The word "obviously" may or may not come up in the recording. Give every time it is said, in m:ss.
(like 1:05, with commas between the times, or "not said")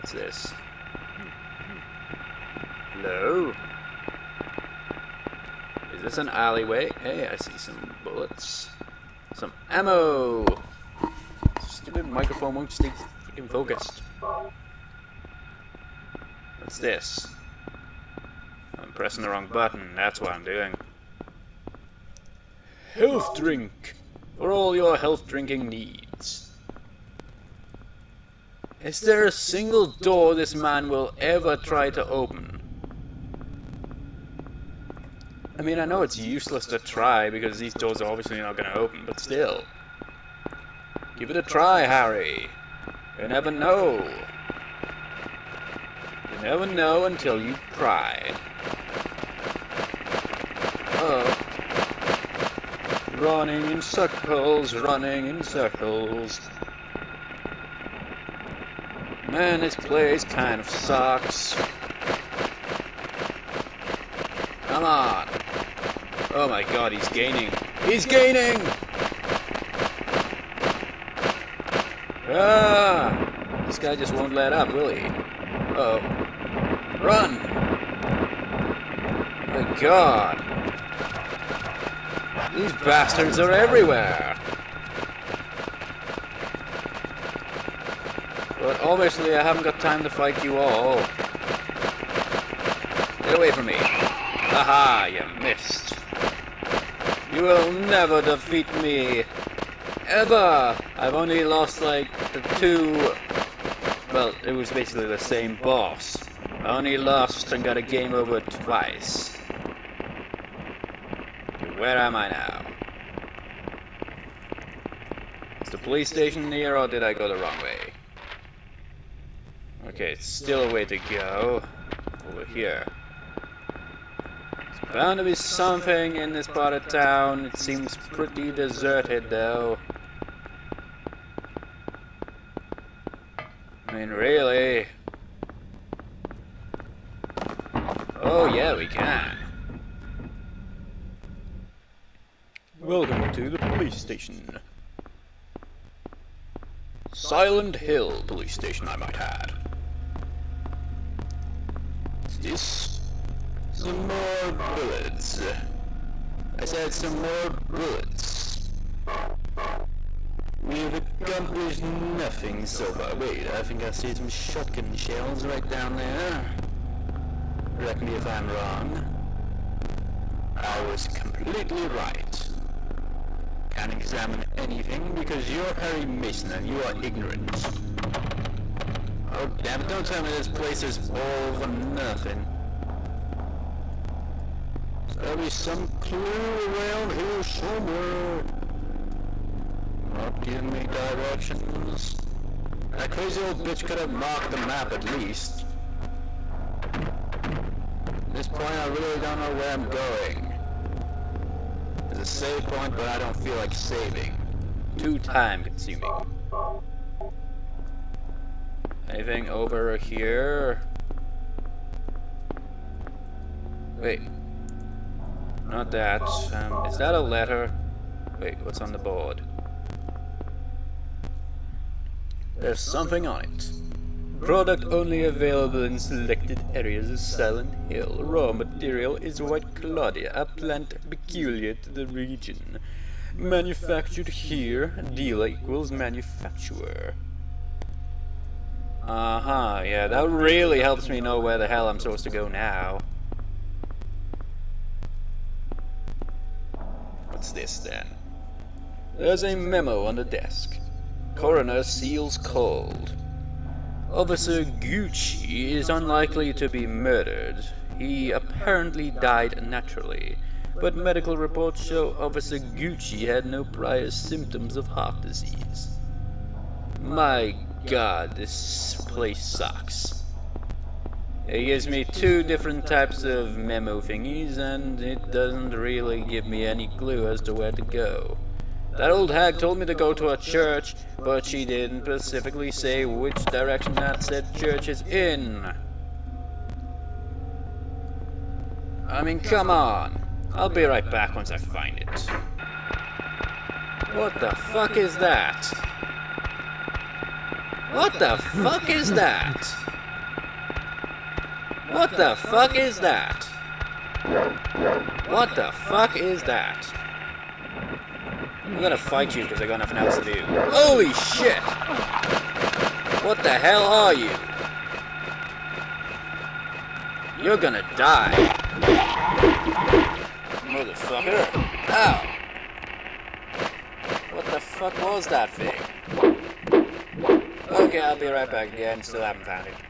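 0:38, 1:28.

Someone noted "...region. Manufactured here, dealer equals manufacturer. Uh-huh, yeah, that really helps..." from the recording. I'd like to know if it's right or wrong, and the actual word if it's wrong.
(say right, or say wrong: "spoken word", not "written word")
right.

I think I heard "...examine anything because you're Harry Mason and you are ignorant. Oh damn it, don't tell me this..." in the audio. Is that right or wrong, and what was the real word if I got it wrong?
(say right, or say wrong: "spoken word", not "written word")
right.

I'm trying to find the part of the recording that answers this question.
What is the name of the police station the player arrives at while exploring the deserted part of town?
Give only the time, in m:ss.
2:27.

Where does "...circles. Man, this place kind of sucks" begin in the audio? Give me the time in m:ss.
0:55.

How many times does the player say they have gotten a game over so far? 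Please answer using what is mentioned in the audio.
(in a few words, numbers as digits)
2.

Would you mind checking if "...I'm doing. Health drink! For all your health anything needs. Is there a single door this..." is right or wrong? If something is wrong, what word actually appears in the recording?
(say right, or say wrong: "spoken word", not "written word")
wrong: "drinking", not "anything".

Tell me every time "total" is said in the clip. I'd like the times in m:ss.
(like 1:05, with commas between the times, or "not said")
not said.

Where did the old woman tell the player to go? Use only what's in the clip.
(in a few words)
A church.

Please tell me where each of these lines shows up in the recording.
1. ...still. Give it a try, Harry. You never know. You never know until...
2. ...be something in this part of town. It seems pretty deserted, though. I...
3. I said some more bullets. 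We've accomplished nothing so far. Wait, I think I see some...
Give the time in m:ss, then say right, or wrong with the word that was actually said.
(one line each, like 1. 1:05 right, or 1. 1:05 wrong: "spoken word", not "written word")
1. 0:39 right
2. 2:05 right
3. 2:36 right.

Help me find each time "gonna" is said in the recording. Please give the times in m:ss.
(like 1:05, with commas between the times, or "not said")
5:08, 5:17.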